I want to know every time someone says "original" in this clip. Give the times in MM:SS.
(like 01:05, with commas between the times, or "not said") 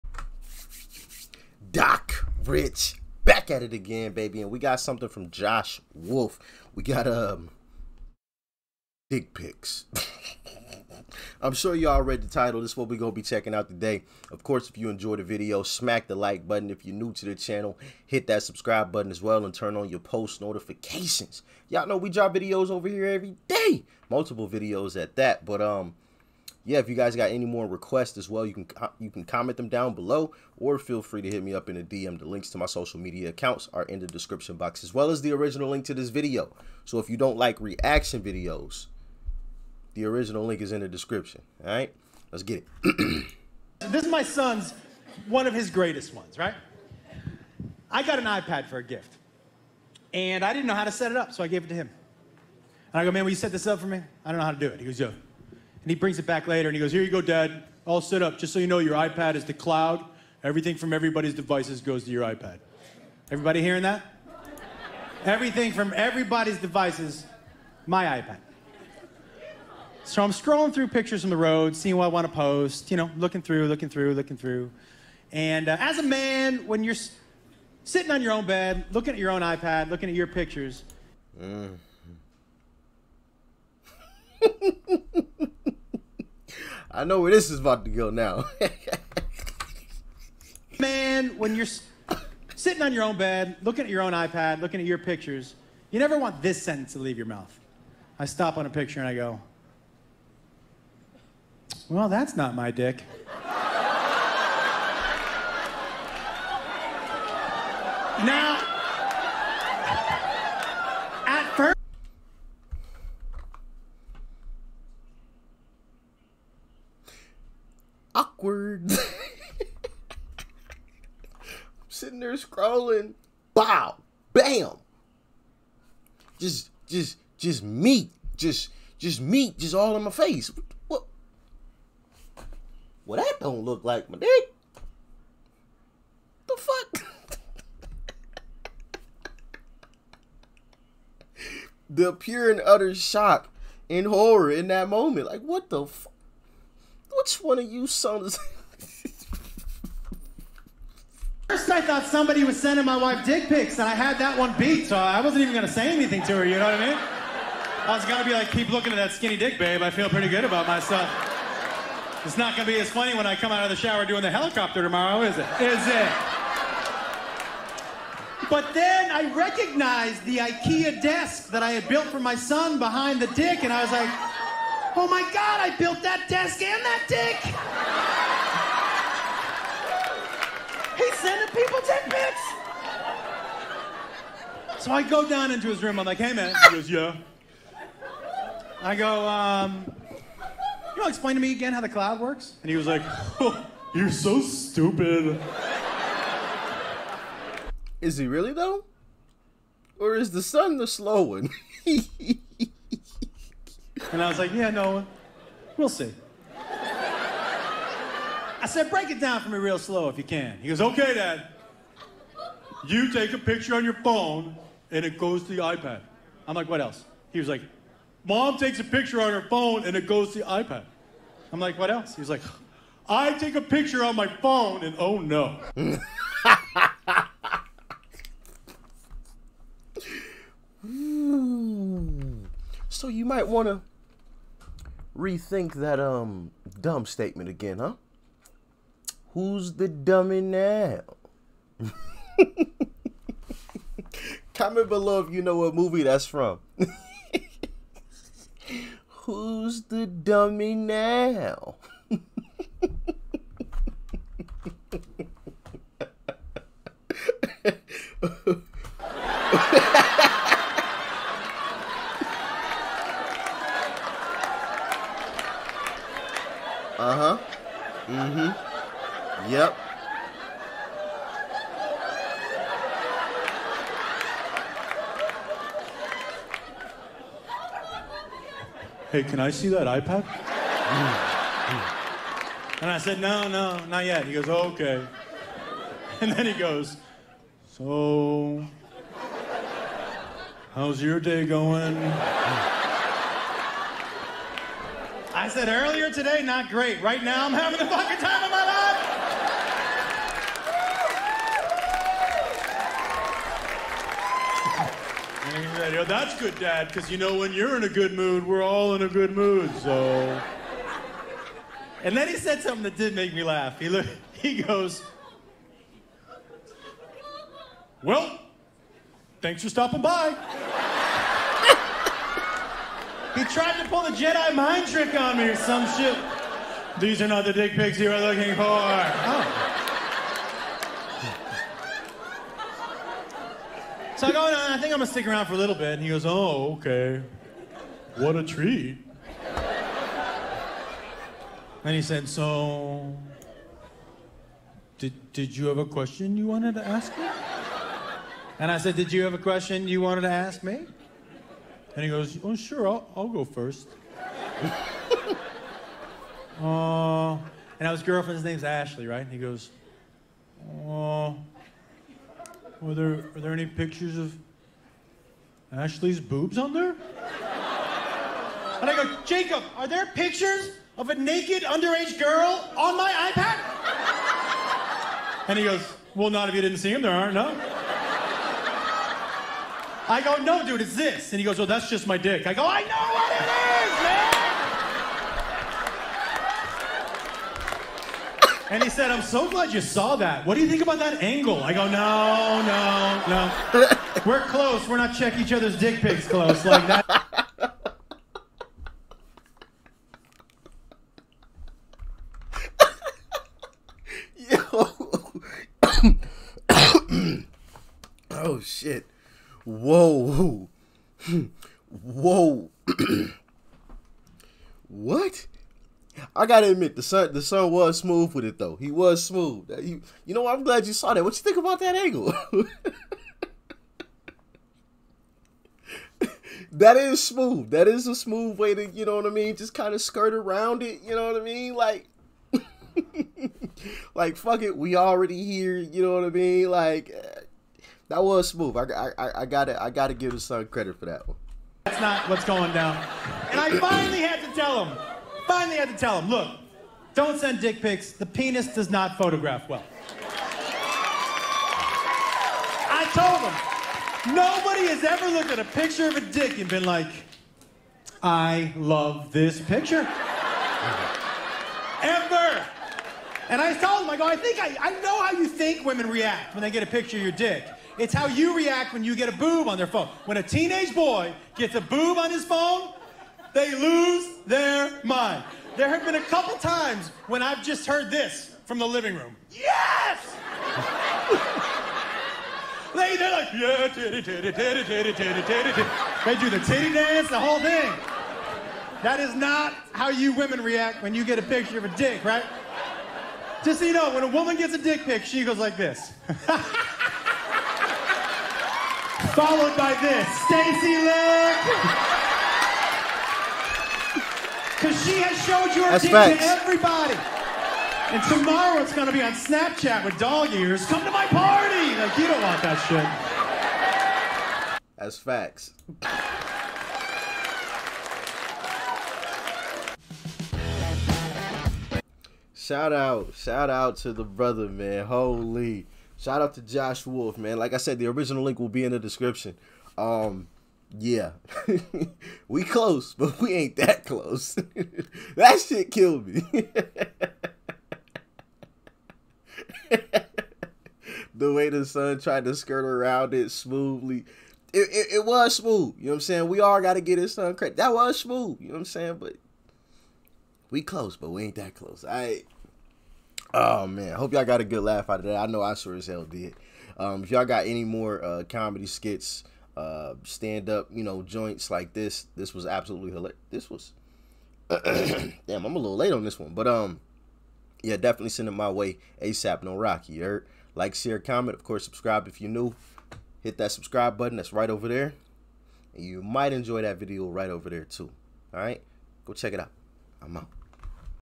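00:35, 00:40, 08:48.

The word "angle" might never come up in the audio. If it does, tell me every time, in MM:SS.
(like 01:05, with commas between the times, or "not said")
06:31, 07:01.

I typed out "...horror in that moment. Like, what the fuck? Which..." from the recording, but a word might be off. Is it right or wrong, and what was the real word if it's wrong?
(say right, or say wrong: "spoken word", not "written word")
right.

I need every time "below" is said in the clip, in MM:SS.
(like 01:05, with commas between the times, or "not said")
00:29, 04:04.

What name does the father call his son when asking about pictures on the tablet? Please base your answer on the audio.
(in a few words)
Jacob.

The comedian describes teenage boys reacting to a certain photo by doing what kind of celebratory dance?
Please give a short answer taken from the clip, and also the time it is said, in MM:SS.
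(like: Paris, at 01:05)
the titty dance, at 08:06.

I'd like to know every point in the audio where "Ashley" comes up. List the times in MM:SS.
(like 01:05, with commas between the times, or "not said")
05:58, 06:05.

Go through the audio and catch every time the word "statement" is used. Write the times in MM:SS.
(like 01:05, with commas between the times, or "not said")
03:57.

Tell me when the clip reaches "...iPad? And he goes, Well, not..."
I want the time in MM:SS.
06:13.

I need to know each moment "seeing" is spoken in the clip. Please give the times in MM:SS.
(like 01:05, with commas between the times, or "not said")
01:11.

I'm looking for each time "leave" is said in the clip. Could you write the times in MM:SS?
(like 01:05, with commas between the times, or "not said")
01:36.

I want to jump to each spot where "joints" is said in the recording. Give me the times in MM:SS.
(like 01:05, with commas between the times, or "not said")
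09:21.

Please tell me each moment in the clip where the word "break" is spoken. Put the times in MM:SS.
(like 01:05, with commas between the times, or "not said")
03:28.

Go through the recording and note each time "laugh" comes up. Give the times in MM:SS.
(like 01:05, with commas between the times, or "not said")
05:13, 09:14.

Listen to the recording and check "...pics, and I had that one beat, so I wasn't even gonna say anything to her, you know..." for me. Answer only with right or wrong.
right.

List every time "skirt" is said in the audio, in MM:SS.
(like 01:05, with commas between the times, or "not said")
07:10, 09:02.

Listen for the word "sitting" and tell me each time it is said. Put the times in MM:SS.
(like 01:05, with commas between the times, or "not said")
01:17, 01:32.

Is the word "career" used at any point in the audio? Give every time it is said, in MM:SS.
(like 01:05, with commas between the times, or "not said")
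not said.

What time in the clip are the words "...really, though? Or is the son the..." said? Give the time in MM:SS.
03:18.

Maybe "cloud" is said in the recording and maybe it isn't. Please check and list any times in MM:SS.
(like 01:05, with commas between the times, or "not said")
00:59, 03:11.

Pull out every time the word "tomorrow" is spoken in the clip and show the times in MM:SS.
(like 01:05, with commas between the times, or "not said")
02:44, 08:28.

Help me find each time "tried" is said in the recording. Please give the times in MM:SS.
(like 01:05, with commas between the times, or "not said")
05:23, 09:02.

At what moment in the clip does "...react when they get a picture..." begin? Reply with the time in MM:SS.
07:46.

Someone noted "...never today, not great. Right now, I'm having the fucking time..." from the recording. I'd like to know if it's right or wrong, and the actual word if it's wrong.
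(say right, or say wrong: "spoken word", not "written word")
wrong: "earlier", not "never".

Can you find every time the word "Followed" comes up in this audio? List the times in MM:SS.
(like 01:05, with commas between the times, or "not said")
08:19.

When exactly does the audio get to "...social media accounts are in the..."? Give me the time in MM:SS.
00:32.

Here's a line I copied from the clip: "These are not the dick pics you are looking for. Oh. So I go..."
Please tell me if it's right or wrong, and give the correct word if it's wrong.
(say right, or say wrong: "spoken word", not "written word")
right.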